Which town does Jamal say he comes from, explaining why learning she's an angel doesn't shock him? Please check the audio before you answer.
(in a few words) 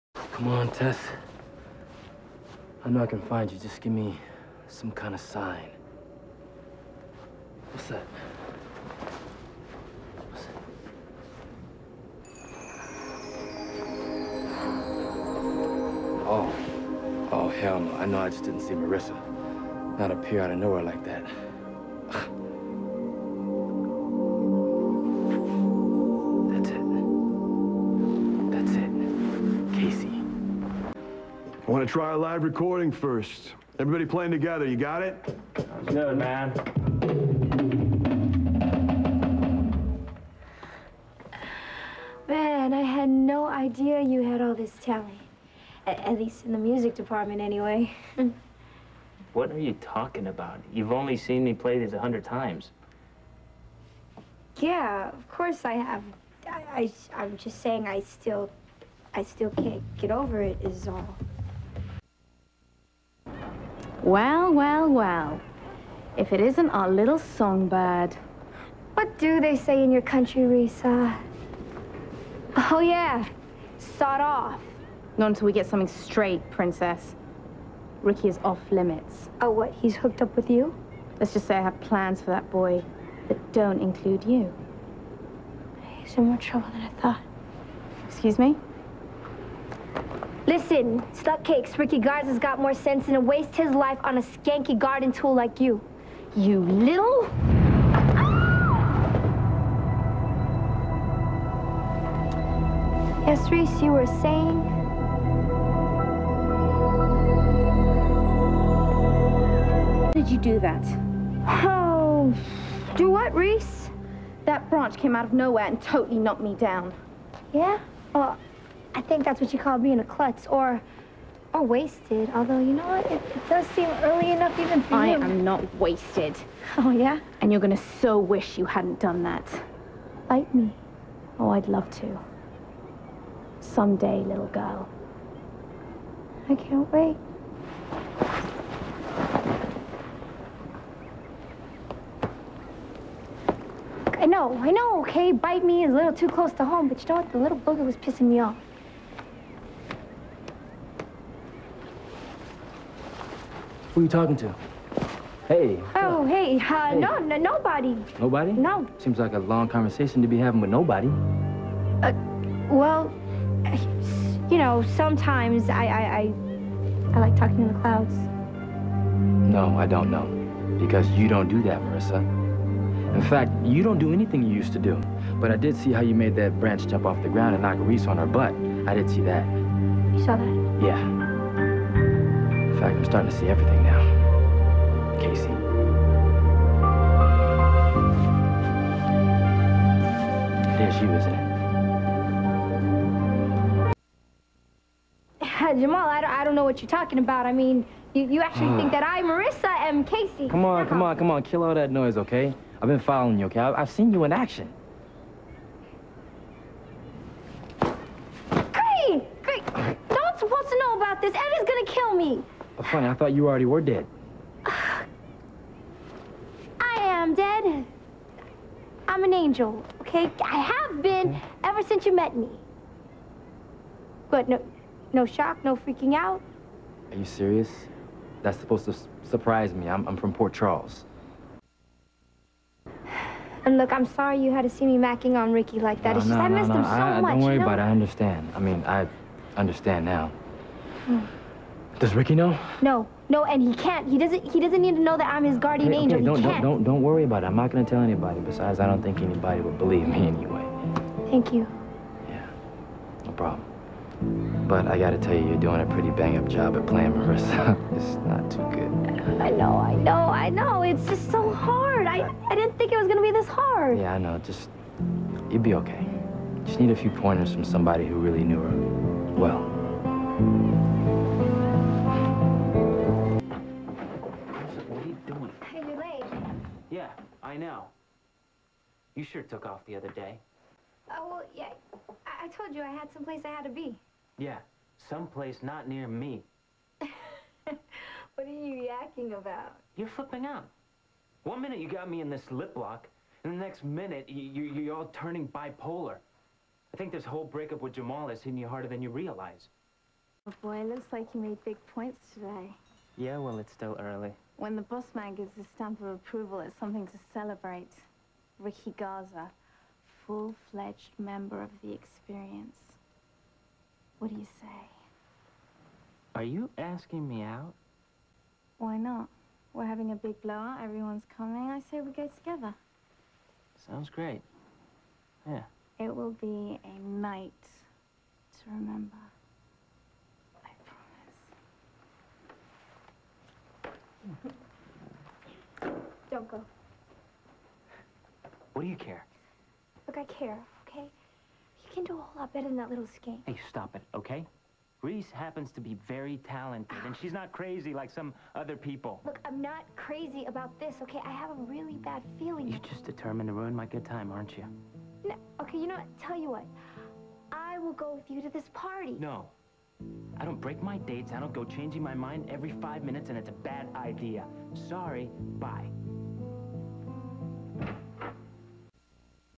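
Port Charles.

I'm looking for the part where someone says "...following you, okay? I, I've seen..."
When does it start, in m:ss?
3:22.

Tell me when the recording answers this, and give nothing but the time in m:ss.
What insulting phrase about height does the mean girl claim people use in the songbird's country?
1:13.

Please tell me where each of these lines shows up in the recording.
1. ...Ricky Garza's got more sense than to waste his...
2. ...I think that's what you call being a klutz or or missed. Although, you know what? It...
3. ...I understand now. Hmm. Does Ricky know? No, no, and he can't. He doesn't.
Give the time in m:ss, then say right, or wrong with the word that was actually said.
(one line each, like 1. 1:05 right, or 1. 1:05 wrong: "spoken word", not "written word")
1. 1:31 right
2. 1:58 wrong: "wasted", not "missed"
3. 3:58 right.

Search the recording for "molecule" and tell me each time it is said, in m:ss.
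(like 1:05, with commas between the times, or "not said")
not said.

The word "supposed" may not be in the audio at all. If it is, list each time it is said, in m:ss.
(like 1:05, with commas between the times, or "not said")
3:30, 3:48.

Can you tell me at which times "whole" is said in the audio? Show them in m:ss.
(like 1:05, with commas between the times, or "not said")
4:57, 5:42.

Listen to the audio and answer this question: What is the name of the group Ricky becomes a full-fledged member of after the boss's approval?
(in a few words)
The Experience.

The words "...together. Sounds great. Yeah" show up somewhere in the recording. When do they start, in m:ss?
5:22.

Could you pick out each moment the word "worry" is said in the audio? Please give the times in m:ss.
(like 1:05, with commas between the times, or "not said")
3:57, 4:07.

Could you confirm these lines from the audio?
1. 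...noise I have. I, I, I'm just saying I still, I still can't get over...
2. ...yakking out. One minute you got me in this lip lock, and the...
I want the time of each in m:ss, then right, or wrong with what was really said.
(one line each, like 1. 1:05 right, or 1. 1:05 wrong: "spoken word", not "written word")
1. 0:55 wrong: "course", not "noise"
2. 4:50 wrong: "flipping", not "yakking".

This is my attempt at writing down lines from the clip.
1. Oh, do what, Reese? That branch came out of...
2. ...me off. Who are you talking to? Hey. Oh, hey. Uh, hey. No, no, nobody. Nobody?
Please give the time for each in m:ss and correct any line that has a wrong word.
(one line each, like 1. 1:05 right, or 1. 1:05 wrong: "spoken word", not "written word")
1. 1:51 right
2. 2:28 right.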